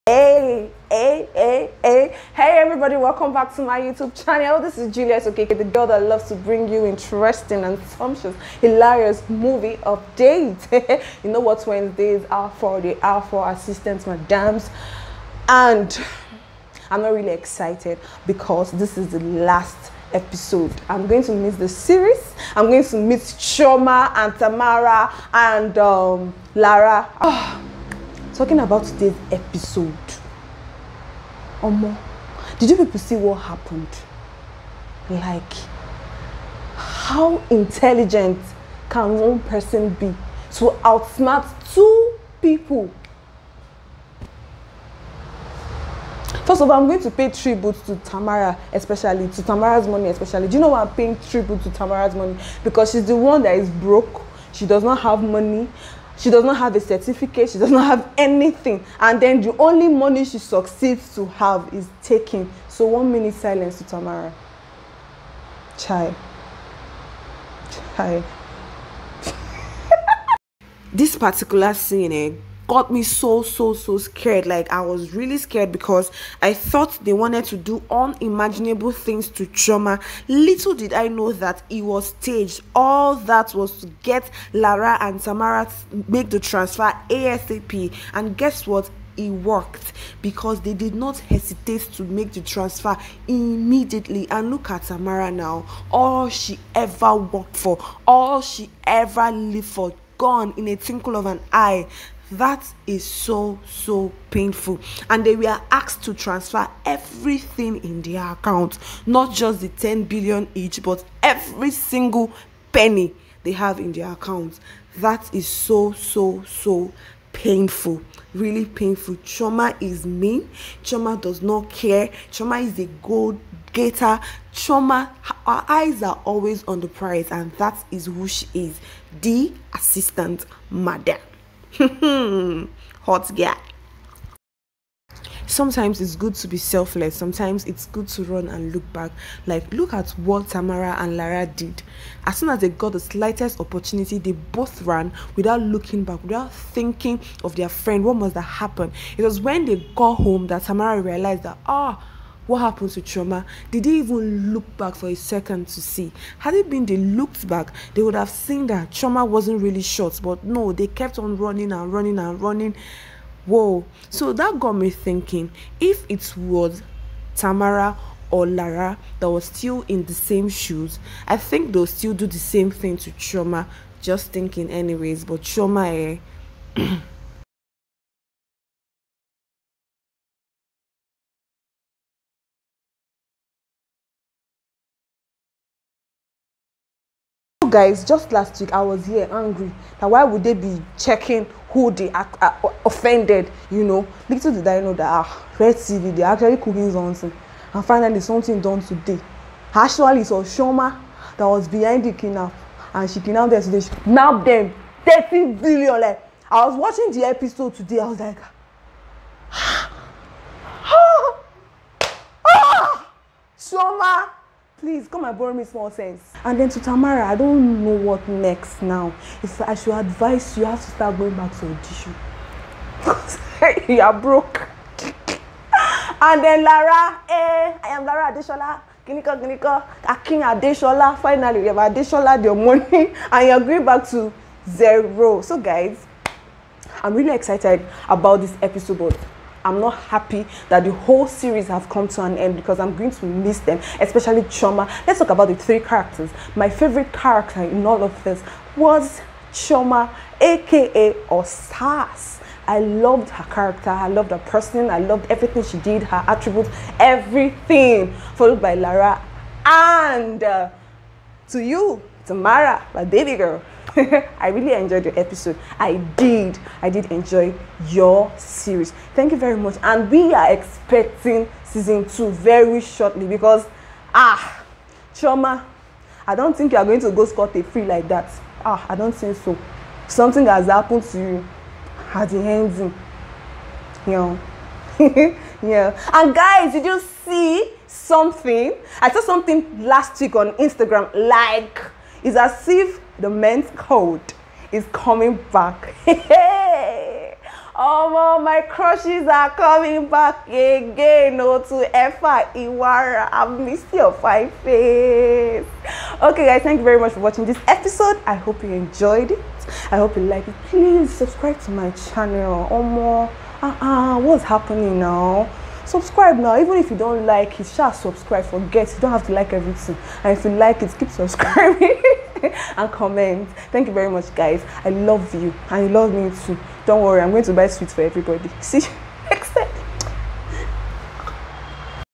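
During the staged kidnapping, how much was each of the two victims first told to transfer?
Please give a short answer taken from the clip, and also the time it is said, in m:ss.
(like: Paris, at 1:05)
10 billion, at 1:49.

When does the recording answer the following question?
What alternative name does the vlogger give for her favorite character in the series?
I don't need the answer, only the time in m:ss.
4:11.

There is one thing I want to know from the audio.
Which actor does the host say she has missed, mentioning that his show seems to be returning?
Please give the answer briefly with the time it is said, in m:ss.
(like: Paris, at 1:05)
Efa Iwara, at 5:01.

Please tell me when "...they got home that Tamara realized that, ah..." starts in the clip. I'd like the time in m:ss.
2:29.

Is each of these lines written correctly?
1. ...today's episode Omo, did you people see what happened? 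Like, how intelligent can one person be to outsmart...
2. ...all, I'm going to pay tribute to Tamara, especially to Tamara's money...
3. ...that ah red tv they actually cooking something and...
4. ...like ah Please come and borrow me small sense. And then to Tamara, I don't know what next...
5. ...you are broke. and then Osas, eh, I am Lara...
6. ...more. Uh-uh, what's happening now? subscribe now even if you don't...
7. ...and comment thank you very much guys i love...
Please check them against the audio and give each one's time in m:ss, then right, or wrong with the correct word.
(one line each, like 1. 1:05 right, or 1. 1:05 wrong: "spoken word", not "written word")
1. 0:28 right
2. 0:46 right
3. 3:14 right
4. 3:28 right
5. 3:43 wrong: "Lara", not "Osas"
6. 5:12 right
7. 5:22 right.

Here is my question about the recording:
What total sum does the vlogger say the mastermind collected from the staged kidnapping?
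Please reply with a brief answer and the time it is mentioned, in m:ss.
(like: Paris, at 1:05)
30 billion, at 3:25.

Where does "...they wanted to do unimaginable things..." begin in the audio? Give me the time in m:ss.
1:17.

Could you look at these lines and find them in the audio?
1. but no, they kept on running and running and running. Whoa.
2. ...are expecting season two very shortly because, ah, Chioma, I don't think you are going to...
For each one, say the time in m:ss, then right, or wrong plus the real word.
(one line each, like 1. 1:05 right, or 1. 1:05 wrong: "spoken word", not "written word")
1. 2:40 right
2. 4:30 right.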